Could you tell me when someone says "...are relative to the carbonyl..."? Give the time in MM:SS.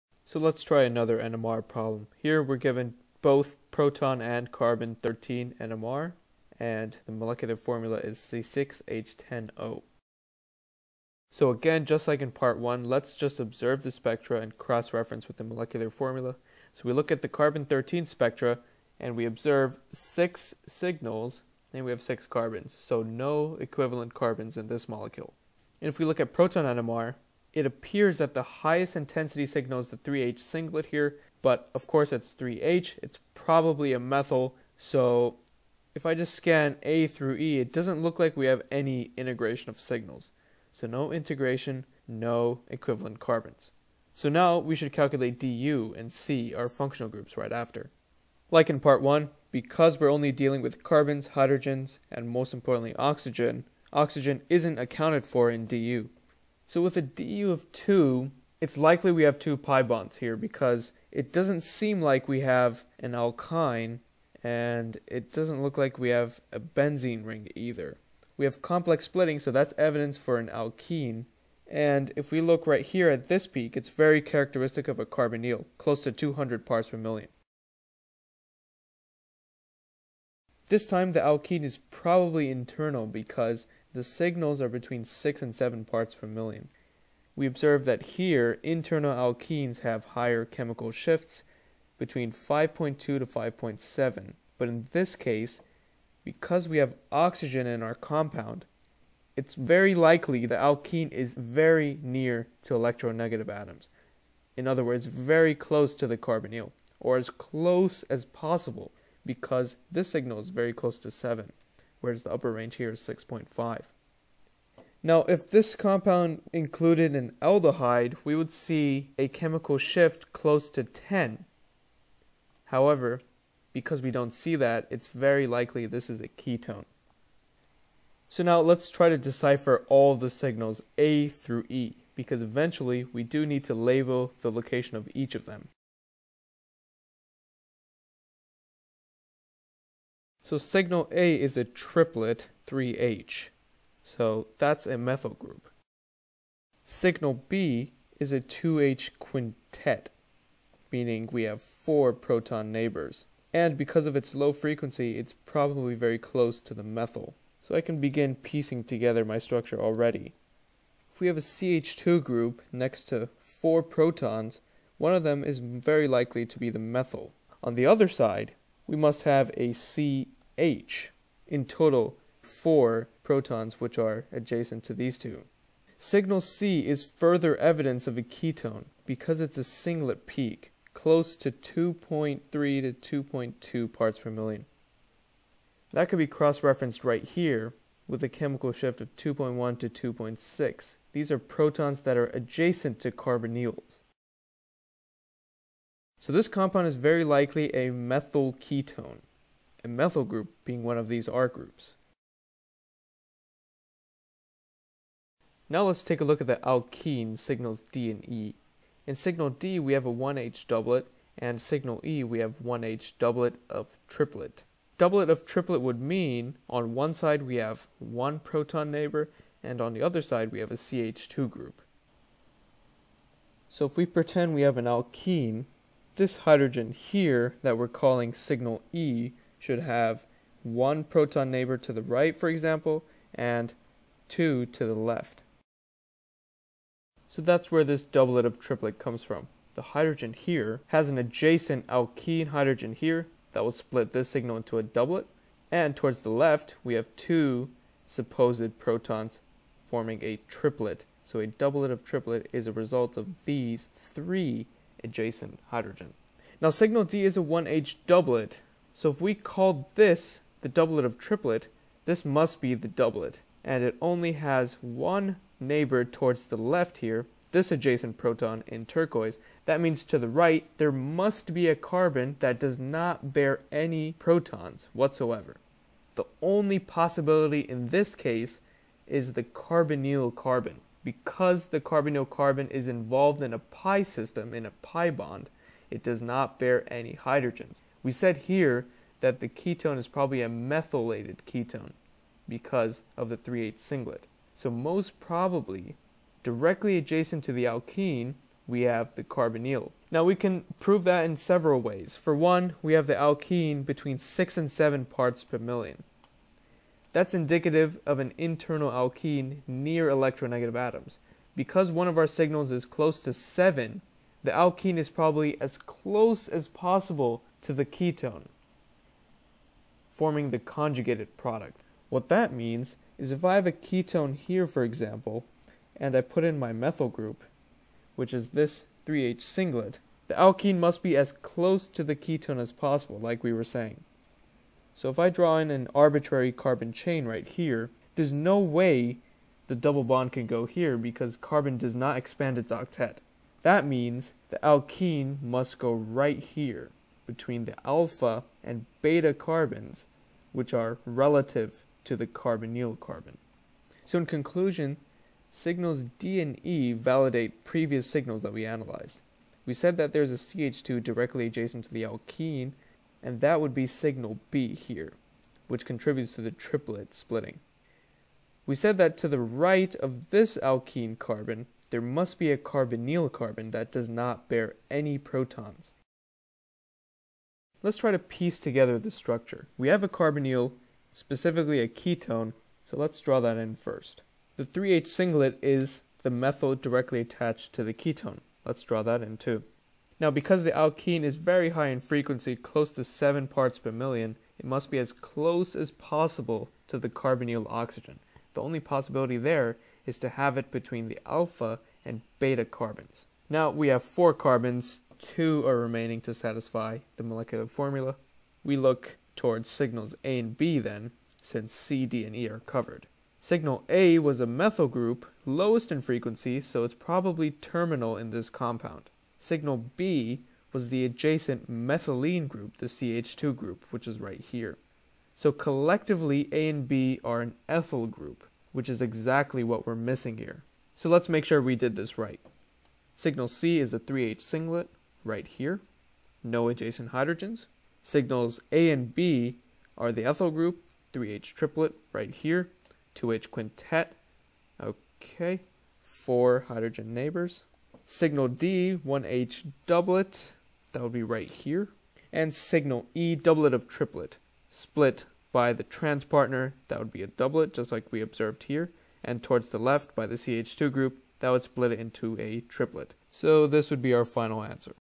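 05:50.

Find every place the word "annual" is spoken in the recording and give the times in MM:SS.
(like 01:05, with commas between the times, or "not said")
not said.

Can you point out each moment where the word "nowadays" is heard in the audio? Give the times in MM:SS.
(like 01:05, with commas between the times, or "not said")
not said.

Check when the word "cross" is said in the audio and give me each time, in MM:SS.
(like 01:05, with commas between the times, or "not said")
00:14, 03:06.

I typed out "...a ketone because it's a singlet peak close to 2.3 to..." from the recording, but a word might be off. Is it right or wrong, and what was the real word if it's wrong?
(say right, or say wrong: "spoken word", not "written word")
right.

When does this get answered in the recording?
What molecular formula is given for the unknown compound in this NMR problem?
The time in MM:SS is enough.
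00:08.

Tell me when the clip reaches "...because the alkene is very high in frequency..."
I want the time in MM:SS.
06:30.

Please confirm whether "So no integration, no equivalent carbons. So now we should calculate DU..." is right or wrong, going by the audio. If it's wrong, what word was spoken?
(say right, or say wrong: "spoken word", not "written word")
right.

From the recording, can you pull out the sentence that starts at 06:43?
Now we have four carbons, two are remaining to satisfy the molecular formula.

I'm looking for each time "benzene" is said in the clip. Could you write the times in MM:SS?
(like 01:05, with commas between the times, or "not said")
01:06.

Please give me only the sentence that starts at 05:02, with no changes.
For one, we have the alkene between 6 and 7 parts per million.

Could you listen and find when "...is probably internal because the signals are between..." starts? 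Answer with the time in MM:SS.
01:21.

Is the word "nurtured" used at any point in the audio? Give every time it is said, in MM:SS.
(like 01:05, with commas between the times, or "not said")
not said.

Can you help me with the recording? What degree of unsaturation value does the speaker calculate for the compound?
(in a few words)
2.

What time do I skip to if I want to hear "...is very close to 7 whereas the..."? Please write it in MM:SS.
01:50.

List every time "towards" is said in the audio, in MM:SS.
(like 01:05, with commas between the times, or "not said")
04:05, 04:26, 06:49, 07:39.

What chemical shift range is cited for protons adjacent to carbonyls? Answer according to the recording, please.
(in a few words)
2.1 to 2.6.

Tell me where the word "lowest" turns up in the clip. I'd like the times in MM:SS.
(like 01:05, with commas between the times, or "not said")
06:55.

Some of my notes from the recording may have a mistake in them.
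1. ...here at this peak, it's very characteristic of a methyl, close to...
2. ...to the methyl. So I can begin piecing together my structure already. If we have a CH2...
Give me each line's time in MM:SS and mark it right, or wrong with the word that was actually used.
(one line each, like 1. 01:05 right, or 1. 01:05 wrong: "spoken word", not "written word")
1. 01:12 wrong: "carbonyl", not "methyl"
2. 02:36 right.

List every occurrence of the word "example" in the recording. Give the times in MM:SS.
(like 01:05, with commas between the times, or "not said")
03:52, 05:24.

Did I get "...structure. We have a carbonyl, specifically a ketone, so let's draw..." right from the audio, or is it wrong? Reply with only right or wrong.
right.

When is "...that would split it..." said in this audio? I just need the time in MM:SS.
07:41.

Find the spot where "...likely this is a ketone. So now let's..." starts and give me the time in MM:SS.
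02:05.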